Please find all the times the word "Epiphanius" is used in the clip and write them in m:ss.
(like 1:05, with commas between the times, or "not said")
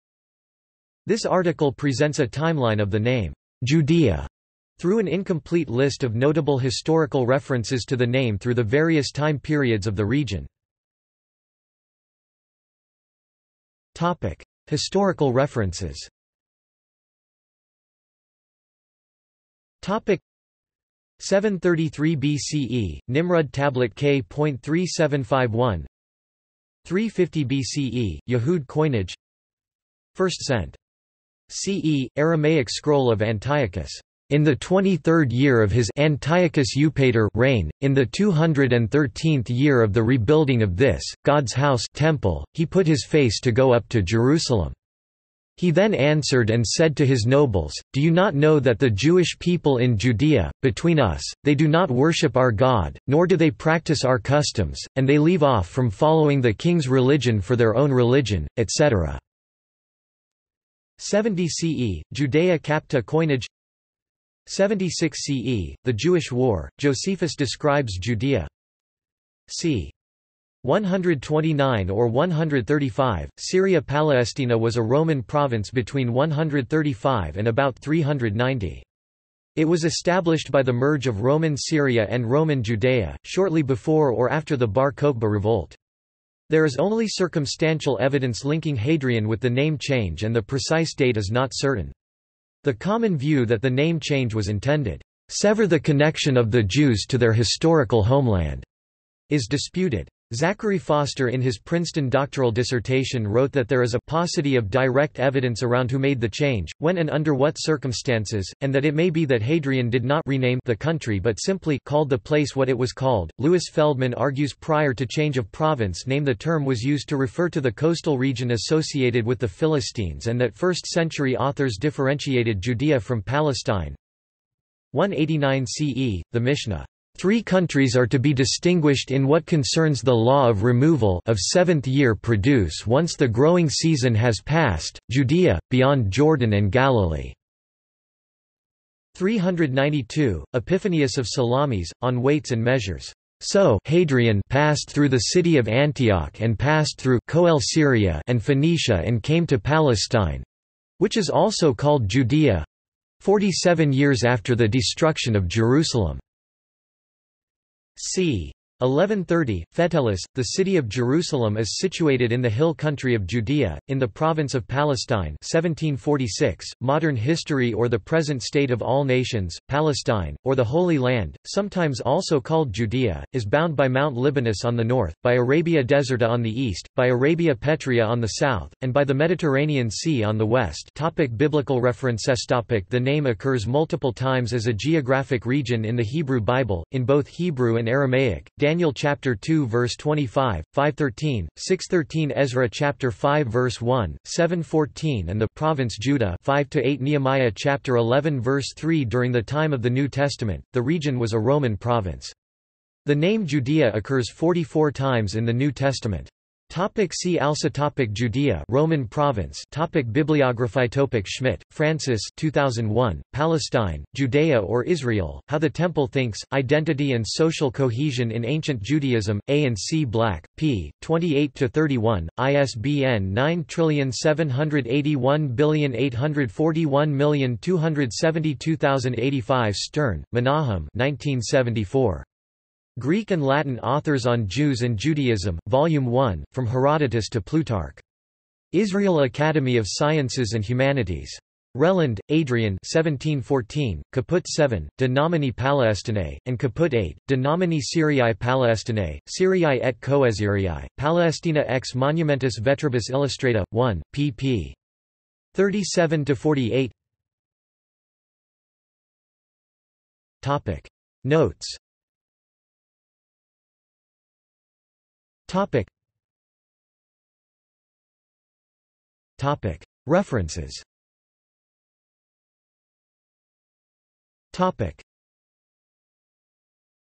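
2:20.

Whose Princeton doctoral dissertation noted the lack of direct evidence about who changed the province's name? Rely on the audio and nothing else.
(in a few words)
Zachary Foster.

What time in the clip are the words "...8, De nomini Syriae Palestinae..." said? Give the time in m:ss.
4:06.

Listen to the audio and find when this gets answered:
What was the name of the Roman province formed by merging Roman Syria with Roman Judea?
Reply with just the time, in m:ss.
1:13.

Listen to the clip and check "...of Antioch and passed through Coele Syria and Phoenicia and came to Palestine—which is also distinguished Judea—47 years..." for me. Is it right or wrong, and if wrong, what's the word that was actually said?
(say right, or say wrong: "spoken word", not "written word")
wrong: "called", not "distinguished".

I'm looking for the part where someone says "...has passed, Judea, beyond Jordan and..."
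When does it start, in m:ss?
2:14.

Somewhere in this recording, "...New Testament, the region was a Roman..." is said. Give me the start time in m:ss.
3:19.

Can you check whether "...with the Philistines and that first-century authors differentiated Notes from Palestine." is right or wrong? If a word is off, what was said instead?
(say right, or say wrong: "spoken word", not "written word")
wrong: "Judea", not "Notes".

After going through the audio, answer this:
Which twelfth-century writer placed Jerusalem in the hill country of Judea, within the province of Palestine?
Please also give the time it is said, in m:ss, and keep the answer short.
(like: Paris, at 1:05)
Fetellus, at 2:39.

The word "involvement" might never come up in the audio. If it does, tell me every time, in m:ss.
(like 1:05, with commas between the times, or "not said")
not said.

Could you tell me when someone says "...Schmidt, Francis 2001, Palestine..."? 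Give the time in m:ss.
3:31.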